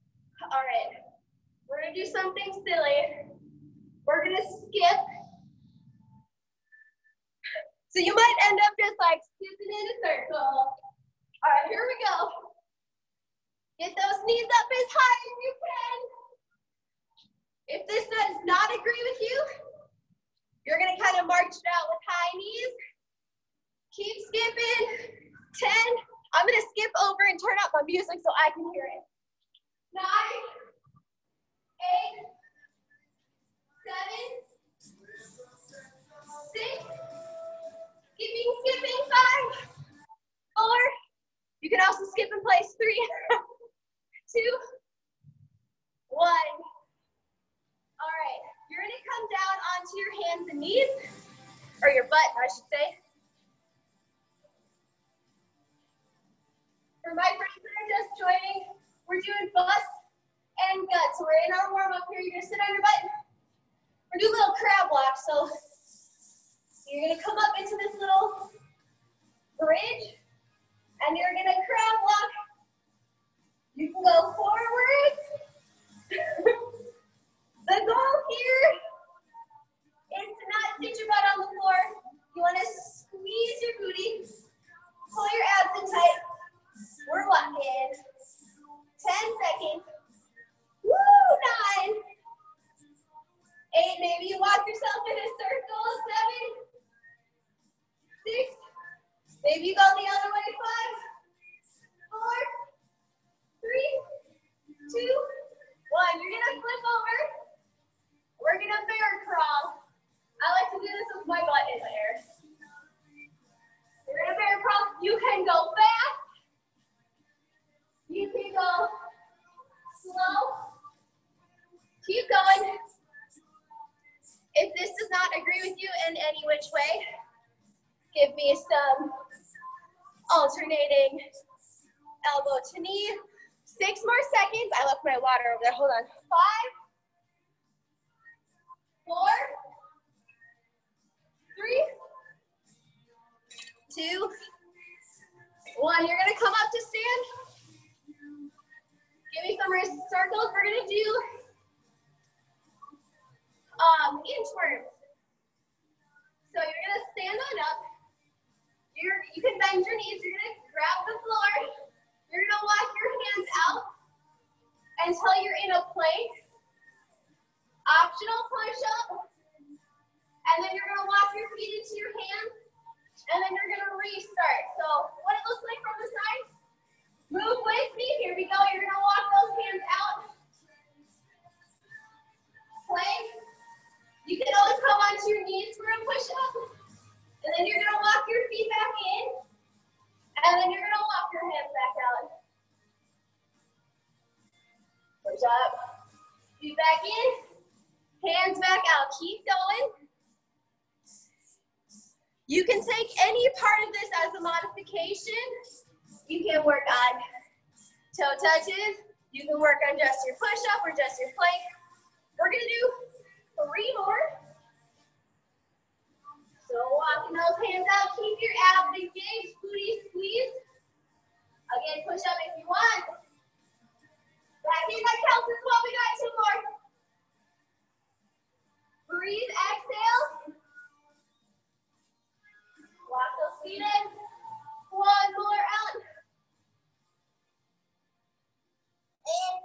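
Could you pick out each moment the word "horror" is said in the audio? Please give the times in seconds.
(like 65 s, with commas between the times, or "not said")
not said.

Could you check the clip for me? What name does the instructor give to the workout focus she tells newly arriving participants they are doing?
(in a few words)
Butts and gut.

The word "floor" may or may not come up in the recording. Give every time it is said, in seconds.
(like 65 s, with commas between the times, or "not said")
81 s, 161 s.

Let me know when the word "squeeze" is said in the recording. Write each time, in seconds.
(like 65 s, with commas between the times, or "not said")
82 s, 220 s.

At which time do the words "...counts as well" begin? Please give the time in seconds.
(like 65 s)
225 s.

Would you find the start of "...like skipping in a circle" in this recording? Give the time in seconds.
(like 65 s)
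8 s.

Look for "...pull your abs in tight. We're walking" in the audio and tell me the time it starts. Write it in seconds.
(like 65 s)
85 s.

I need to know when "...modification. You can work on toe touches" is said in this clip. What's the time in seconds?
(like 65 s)
204 s.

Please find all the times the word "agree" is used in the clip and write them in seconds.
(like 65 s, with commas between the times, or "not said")
18 s, 125 s.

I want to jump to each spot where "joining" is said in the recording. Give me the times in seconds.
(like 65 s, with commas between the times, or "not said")
58 s.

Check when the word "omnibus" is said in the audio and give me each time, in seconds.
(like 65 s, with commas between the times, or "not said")
not said.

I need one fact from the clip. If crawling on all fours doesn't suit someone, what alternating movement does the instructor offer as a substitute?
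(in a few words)
Elbow to knee.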